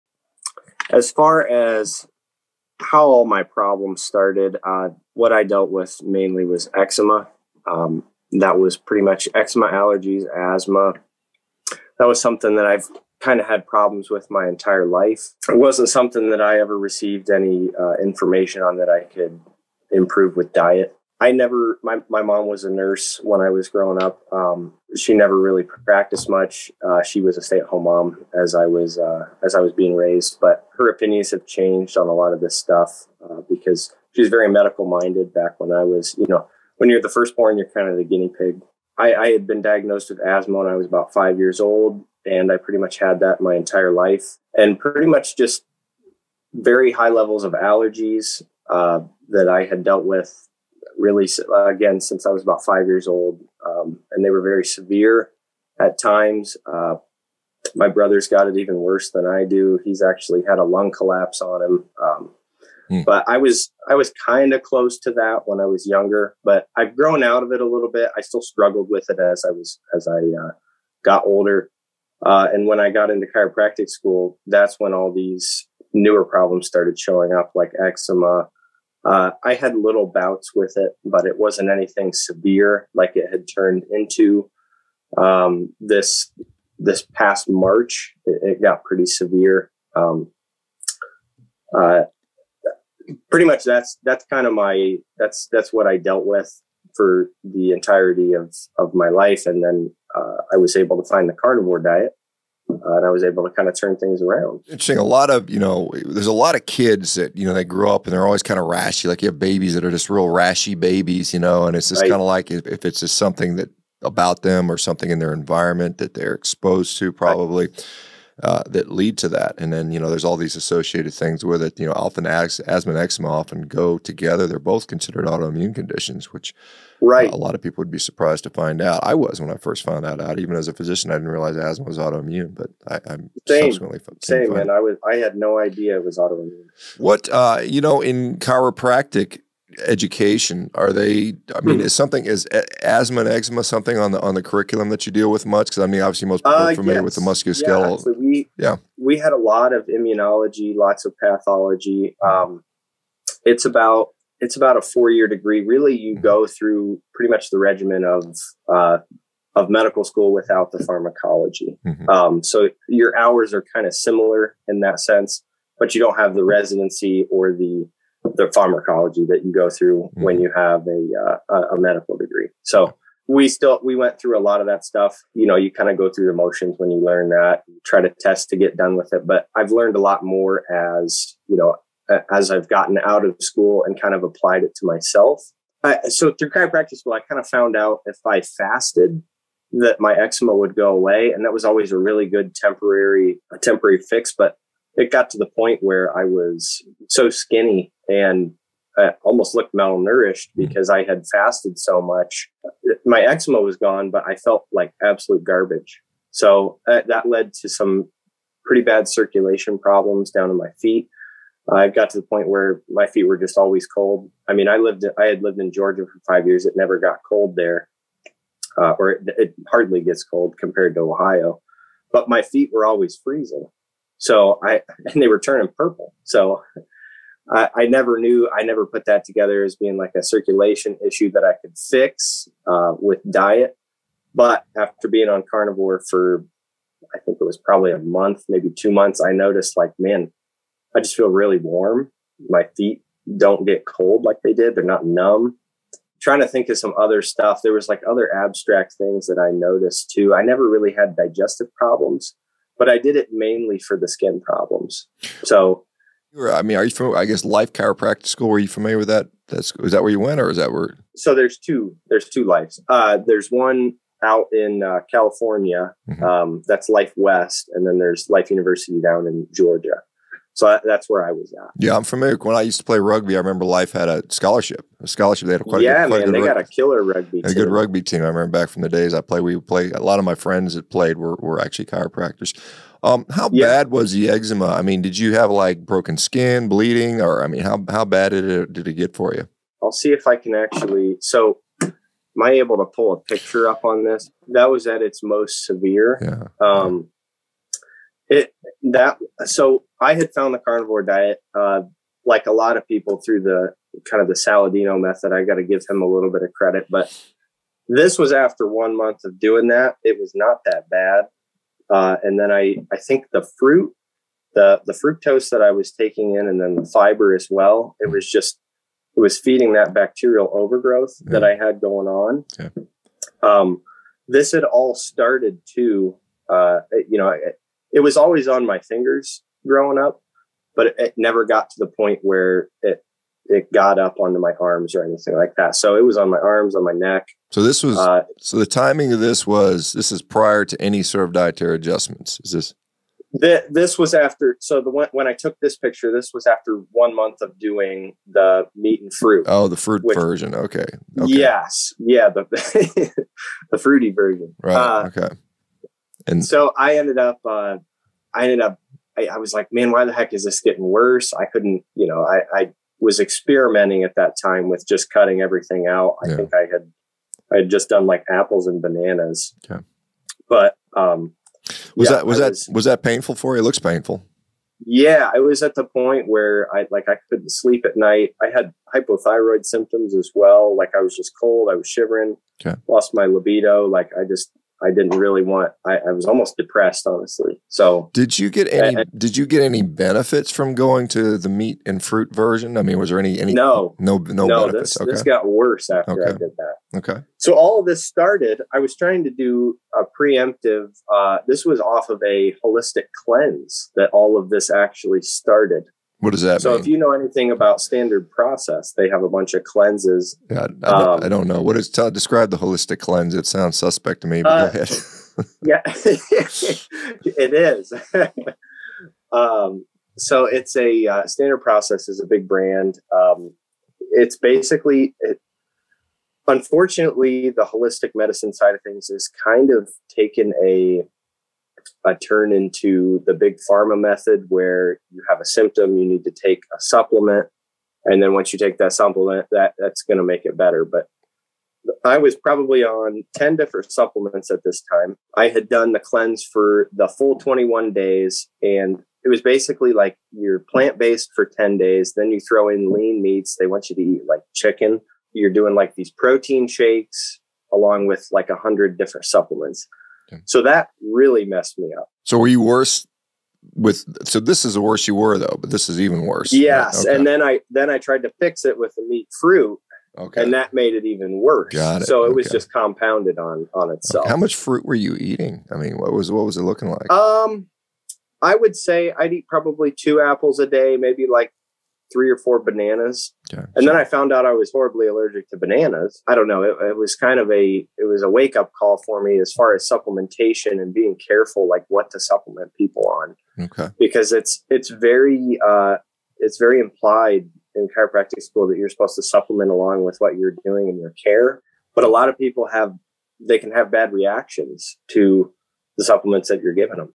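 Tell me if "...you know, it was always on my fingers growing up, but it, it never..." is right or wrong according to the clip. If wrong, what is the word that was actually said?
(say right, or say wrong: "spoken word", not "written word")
right.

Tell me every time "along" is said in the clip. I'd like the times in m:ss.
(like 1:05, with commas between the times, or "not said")
7:37, 8:19.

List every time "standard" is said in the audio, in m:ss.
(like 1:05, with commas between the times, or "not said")
6:47, 7:01.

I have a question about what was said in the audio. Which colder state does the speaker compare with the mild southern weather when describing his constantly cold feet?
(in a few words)
Ohio.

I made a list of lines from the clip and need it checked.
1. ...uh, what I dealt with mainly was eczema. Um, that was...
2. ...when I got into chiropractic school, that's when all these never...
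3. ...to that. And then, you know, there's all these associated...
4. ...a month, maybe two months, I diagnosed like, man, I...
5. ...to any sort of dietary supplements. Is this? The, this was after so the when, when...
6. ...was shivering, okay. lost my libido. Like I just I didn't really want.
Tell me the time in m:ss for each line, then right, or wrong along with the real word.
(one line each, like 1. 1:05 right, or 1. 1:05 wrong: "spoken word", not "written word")
1. 0:04 right
2. 1:12 wrong: "newer", not "never"
3. 1:59 right
4. 3:57 wrong: "noticed", not "diagnosed"
5. 5:40 wrong: "adjustments", not "supplements"
6. 6:21 right.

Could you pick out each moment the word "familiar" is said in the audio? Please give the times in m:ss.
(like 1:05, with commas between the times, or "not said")
2:26, 4:18, 4:32.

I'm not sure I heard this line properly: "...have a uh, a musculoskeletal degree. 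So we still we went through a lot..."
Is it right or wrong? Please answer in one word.
wrong.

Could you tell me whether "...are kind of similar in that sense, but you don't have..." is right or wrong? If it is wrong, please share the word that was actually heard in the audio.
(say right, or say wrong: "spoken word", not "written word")
right.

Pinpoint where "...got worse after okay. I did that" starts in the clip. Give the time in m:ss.
6:35.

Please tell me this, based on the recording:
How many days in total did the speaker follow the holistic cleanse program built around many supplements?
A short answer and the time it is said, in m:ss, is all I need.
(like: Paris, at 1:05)
21 days, at 7:27.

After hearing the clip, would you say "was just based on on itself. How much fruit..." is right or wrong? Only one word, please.
wrong.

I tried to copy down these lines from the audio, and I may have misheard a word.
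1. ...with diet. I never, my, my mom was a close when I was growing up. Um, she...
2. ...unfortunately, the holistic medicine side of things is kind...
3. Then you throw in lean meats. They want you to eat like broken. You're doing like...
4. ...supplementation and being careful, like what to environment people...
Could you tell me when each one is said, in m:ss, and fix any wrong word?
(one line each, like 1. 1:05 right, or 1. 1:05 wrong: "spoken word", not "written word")
1. 0:20 wrong: "nurse", not "close"
2. 7:06 right
3. 7:32 wrong: "chicken", not "broken"
4. 8:09 wrong: "supplement", not "environment".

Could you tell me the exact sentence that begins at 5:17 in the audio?
It was just it was feeding that bacterial overgrowth yeah.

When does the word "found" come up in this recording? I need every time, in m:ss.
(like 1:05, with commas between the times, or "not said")
2:09, 3:07, 5:00, 8:04.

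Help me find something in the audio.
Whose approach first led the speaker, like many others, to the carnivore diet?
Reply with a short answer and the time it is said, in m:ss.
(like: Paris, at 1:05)
Saladino, at 5:04.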